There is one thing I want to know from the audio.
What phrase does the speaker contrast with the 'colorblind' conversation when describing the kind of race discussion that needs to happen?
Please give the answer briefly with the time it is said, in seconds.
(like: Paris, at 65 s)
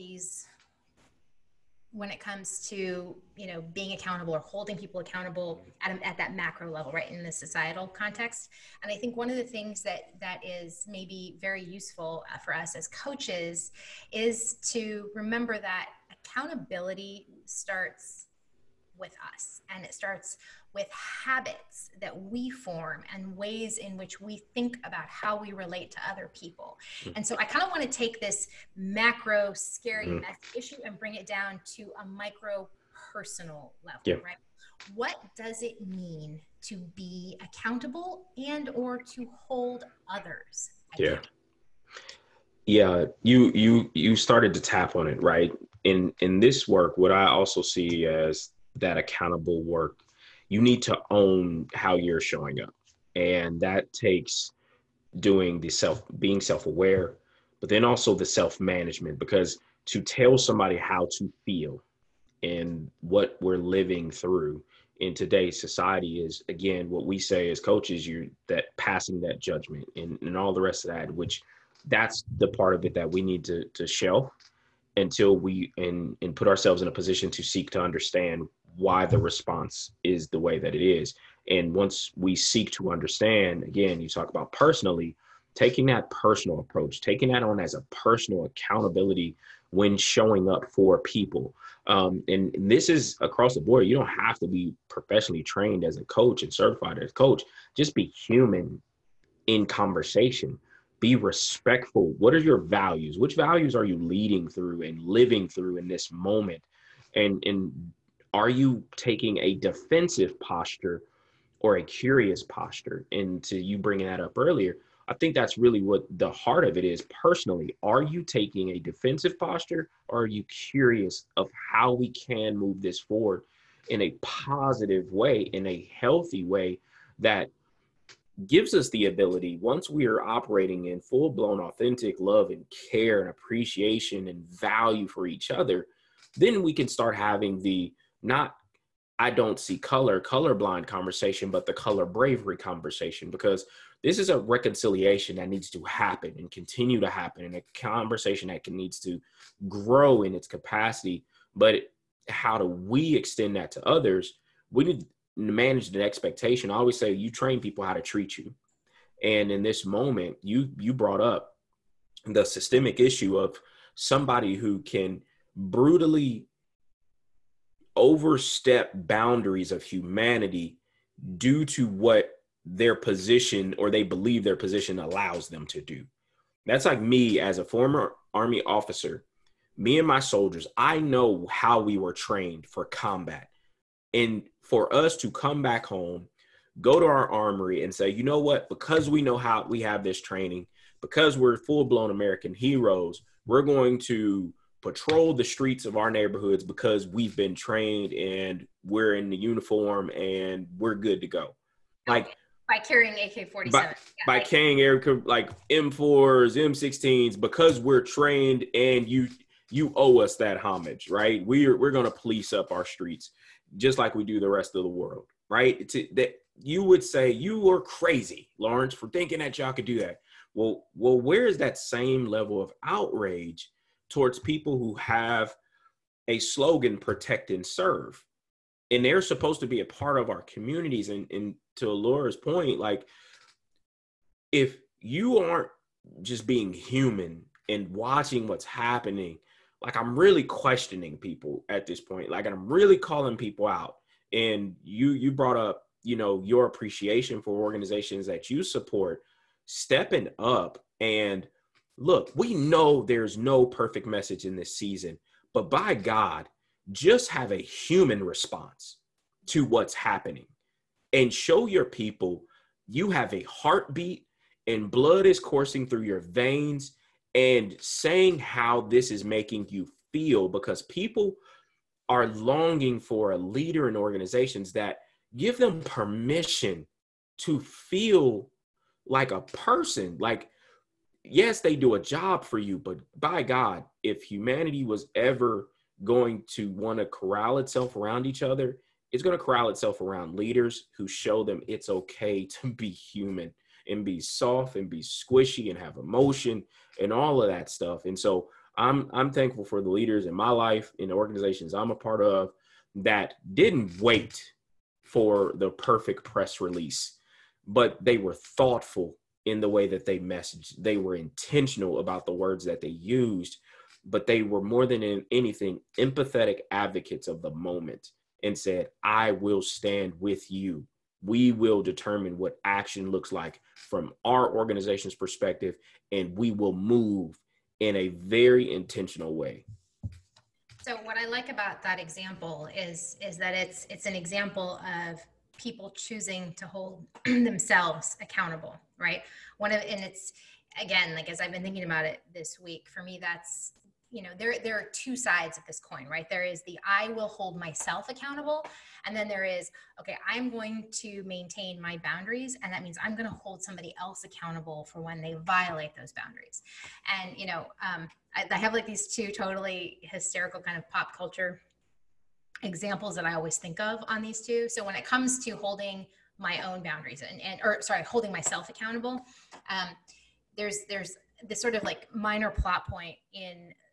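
color bravery, at 141 s.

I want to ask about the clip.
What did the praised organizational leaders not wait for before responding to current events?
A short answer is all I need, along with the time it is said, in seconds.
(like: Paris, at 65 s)
perfect press release, at 305 s.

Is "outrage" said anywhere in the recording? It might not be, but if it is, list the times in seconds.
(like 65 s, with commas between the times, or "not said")
222 s.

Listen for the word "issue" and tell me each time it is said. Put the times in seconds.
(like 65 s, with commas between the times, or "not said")
30 s, 162 s.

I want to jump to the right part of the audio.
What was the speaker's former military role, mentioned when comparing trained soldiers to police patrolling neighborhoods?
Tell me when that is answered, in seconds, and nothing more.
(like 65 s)
177 s.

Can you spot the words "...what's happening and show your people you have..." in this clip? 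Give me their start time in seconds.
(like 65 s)
259 s.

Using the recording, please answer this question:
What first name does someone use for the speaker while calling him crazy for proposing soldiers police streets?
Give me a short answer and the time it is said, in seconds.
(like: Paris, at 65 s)
Lawrence, at 218 s.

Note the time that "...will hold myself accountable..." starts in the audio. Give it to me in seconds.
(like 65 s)
347 s.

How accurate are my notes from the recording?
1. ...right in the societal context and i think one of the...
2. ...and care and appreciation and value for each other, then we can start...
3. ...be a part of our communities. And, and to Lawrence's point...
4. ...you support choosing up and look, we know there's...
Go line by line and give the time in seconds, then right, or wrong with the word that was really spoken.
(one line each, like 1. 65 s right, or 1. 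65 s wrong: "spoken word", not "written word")
1. 6 s right
2. 132 s right
3. 229 s wrong: "Laura", not "Lawrence"
4. 248 s wrong: "stepping", not "choosing".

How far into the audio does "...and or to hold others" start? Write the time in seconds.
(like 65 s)
38 s.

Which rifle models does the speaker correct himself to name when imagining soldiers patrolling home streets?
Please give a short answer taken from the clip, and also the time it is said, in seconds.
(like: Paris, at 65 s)
M4s, M16s, at 205 s.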